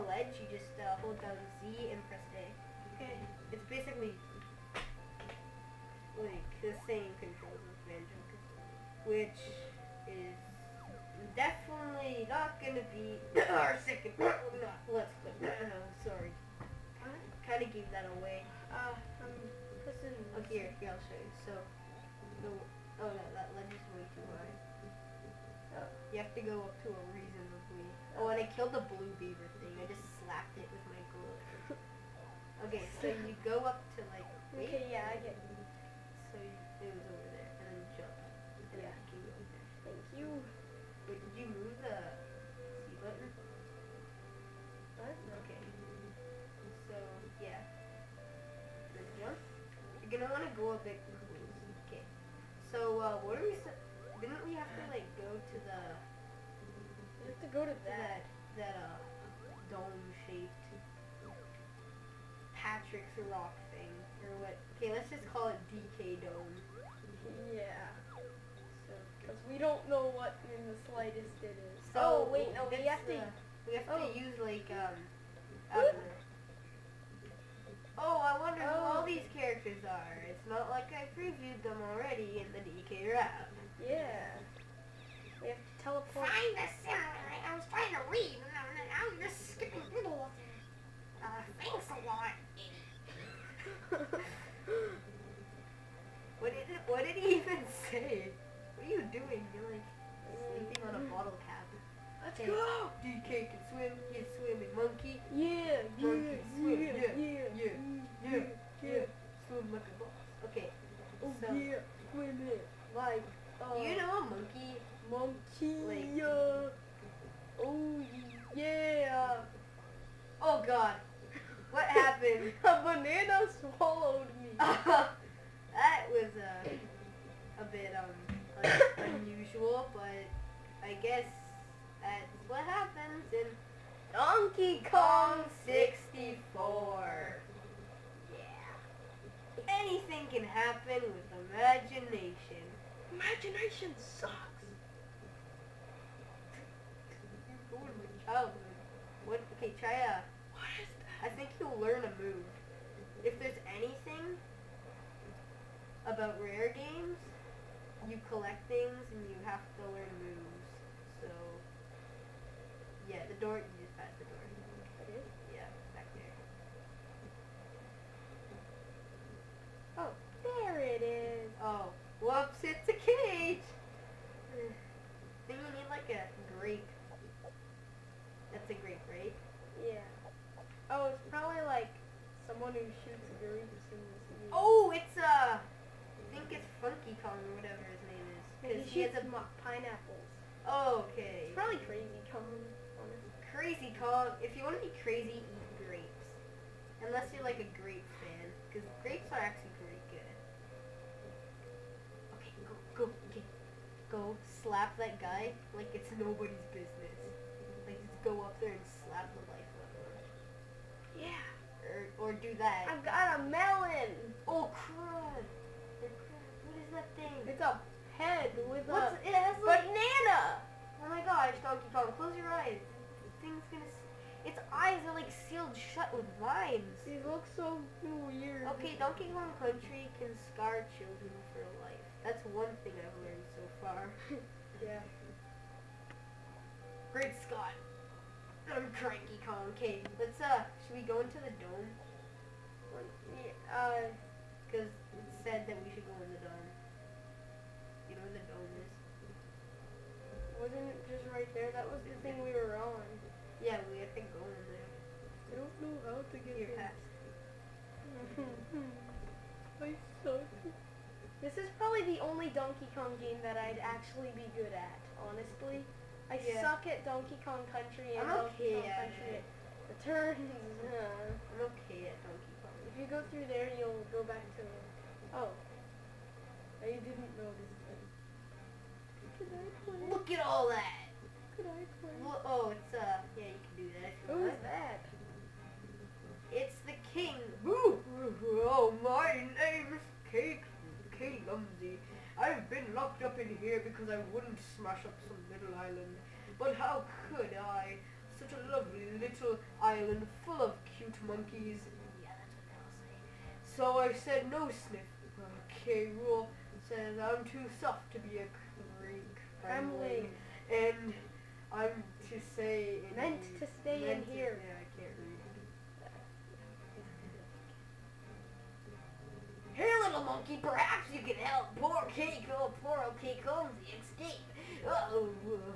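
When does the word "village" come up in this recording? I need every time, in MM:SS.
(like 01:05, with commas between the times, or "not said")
not said.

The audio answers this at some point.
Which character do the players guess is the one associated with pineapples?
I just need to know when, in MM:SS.
03:06.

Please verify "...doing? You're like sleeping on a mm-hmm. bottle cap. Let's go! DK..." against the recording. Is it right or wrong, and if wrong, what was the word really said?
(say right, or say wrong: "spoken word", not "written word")
right.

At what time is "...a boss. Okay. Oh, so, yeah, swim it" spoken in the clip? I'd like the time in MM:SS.
01:49.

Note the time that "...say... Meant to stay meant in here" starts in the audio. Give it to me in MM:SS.
05:12.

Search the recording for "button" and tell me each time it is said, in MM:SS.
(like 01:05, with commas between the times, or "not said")
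00:43.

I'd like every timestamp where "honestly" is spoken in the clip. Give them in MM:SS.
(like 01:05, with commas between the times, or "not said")
03:13, 04:25.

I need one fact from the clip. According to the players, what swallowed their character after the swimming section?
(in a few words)
a banana.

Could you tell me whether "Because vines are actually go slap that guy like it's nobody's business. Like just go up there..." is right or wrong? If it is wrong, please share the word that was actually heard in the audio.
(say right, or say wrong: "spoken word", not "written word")
wrong: "grapes", not "vines".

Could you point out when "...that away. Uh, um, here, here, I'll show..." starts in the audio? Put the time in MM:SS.
00:17.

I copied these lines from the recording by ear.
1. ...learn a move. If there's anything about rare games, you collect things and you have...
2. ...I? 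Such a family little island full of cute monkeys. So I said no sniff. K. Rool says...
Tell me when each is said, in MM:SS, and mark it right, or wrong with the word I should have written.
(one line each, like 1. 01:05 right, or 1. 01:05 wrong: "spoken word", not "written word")
1. 02:31 right
2. 04:57 wrong: "lovely", not "family".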